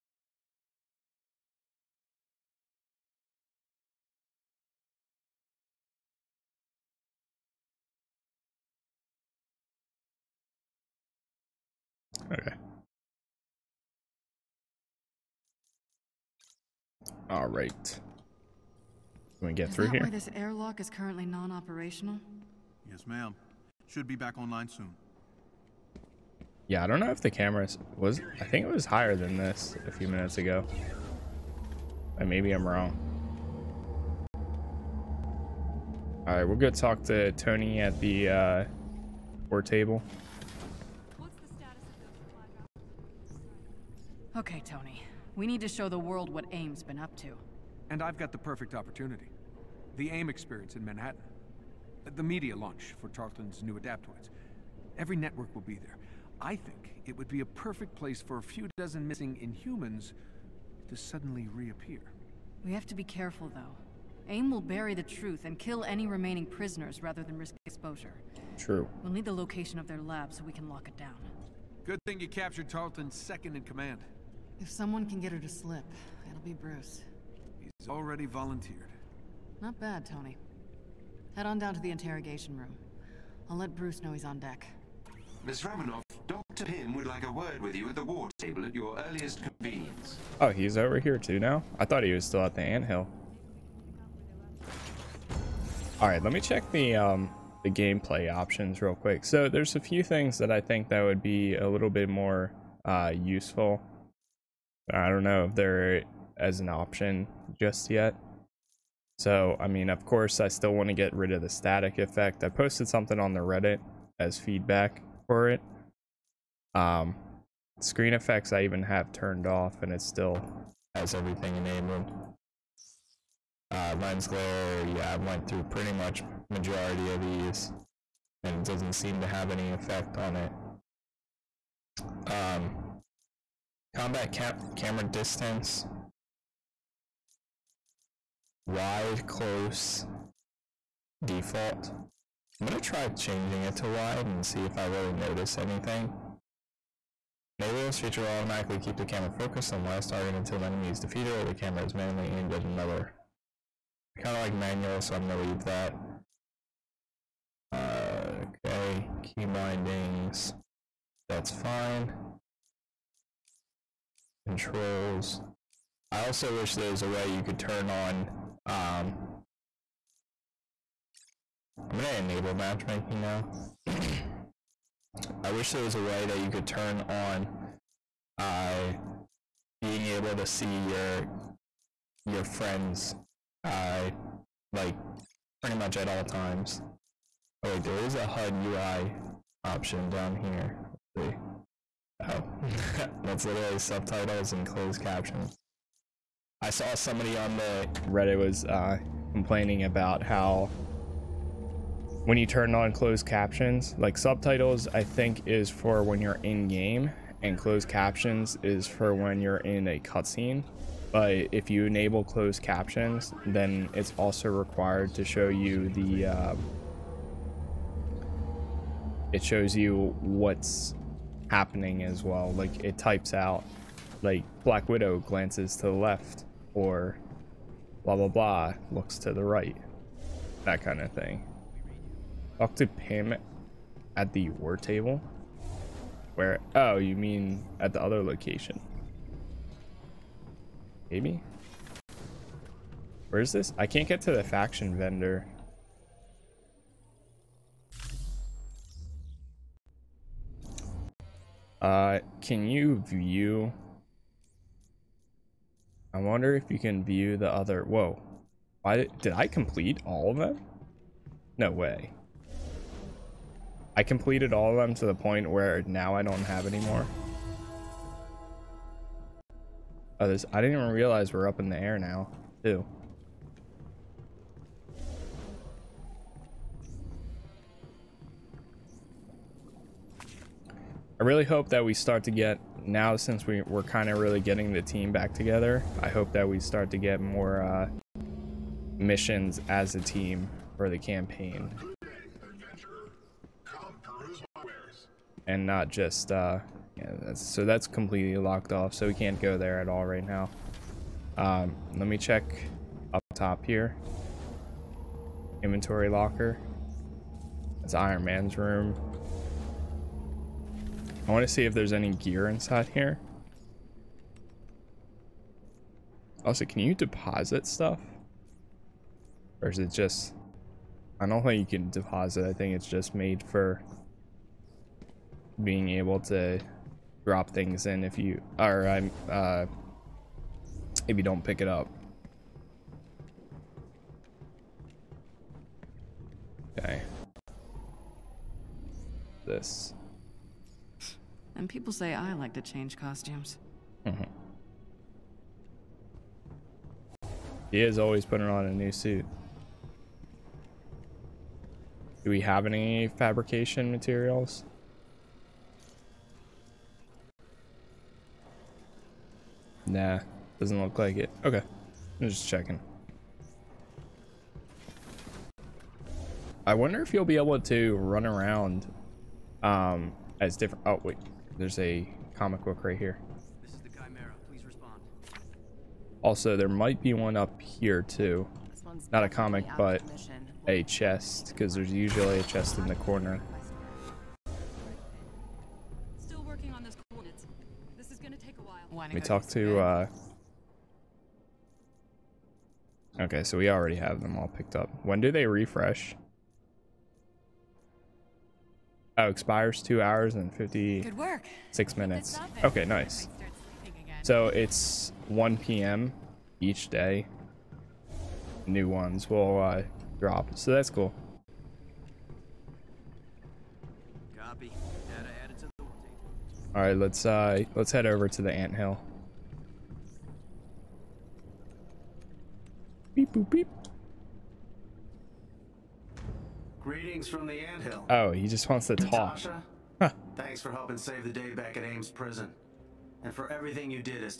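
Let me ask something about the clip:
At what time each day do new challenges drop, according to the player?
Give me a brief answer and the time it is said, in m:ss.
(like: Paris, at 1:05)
1 p.m., at 6:45.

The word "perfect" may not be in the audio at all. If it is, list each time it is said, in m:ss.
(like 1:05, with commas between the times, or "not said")
0:48, 0:57.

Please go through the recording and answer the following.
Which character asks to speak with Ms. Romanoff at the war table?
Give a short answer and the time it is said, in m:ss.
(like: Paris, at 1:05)
Dr. Pym, at 1:26.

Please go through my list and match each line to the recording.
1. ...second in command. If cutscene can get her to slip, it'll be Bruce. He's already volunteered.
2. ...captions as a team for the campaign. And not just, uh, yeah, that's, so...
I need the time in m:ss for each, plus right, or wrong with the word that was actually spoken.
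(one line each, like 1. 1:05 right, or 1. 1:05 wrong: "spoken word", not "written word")
1. 1:13 wrong: "someone", not "cutscene"
2. 4:48 wrong: "missions", not "captions".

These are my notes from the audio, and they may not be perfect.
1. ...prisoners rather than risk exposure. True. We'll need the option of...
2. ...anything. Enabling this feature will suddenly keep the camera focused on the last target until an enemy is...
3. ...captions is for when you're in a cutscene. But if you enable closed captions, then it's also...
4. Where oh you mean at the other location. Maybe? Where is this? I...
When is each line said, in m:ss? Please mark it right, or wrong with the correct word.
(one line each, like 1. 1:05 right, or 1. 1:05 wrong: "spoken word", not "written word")
1. 1:06 wrong: "location", not "option"
2. 2:25 wrong: "automatically", not "suddenly"
3. 3:27 right
4. 3:56 right.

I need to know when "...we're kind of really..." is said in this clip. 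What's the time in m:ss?
4:43.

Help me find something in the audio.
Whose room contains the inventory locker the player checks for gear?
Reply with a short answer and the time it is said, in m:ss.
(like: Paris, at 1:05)
Iron Man, at 5:07.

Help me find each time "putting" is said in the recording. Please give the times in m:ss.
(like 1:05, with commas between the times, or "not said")
5:48.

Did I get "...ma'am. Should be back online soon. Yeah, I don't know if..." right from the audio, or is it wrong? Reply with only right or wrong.
right.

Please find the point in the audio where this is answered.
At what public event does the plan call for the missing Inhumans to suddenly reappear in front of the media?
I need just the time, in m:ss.
0:49.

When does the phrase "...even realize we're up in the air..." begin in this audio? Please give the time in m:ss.
4:30.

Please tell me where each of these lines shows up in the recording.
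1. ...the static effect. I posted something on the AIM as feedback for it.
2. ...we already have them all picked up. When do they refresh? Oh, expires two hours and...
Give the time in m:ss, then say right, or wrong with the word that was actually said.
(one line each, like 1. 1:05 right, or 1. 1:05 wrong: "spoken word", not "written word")
1. 1:51 wrong: "Reddit", not "AIM"
2. 6:33 right.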